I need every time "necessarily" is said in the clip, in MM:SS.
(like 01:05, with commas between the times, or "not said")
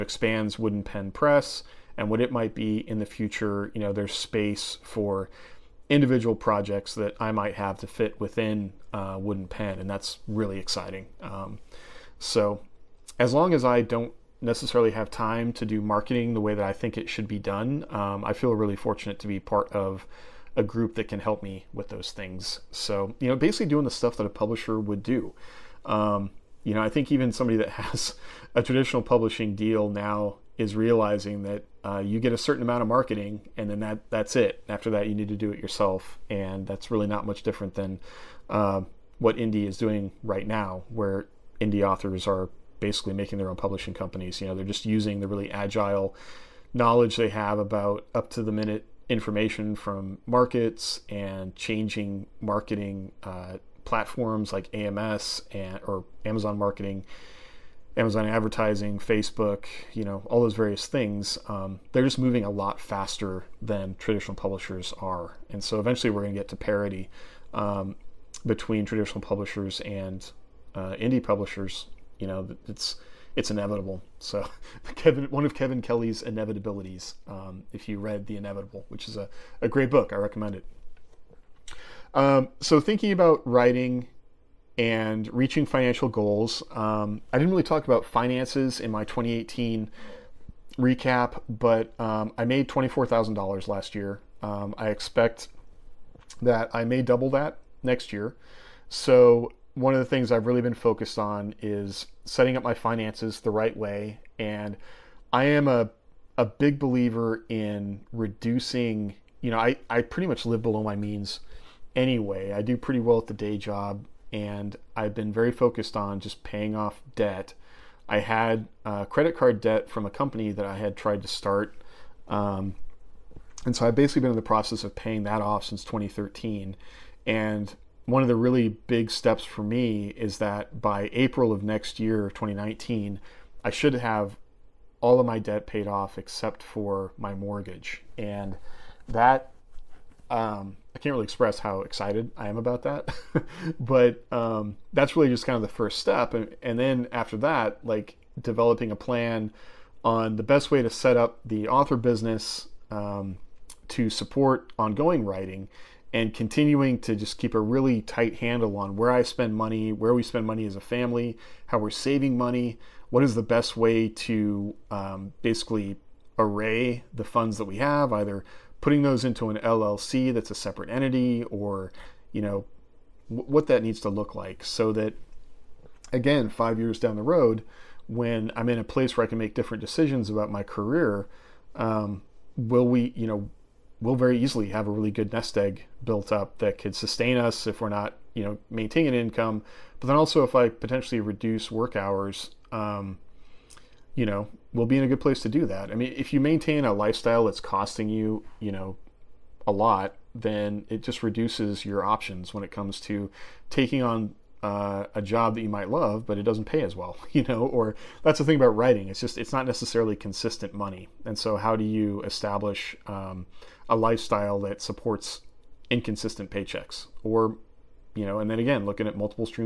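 00:14, 03:29.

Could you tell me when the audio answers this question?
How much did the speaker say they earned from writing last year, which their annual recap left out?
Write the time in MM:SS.
01:32.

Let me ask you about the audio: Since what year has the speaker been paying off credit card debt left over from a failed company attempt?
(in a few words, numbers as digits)
2013.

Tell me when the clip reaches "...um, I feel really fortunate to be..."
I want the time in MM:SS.
00:17.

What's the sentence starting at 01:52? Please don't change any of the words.
I do pretty well at the day job, and I've been very focused on just paying off debt.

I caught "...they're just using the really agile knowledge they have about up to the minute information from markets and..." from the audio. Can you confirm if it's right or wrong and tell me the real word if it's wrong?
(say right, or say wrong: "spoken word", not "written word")
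right.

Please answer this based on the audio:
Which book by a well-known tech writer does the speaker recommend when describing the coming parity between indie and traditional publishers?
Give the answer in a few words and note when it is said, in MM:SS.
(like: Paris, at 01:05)
The Inevitable, at 01:18.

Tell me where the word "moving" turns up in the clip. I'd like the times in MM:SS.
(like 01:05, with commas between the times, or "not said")
01:02.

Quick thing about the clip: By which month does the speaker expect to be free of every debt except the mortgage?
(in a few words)
April.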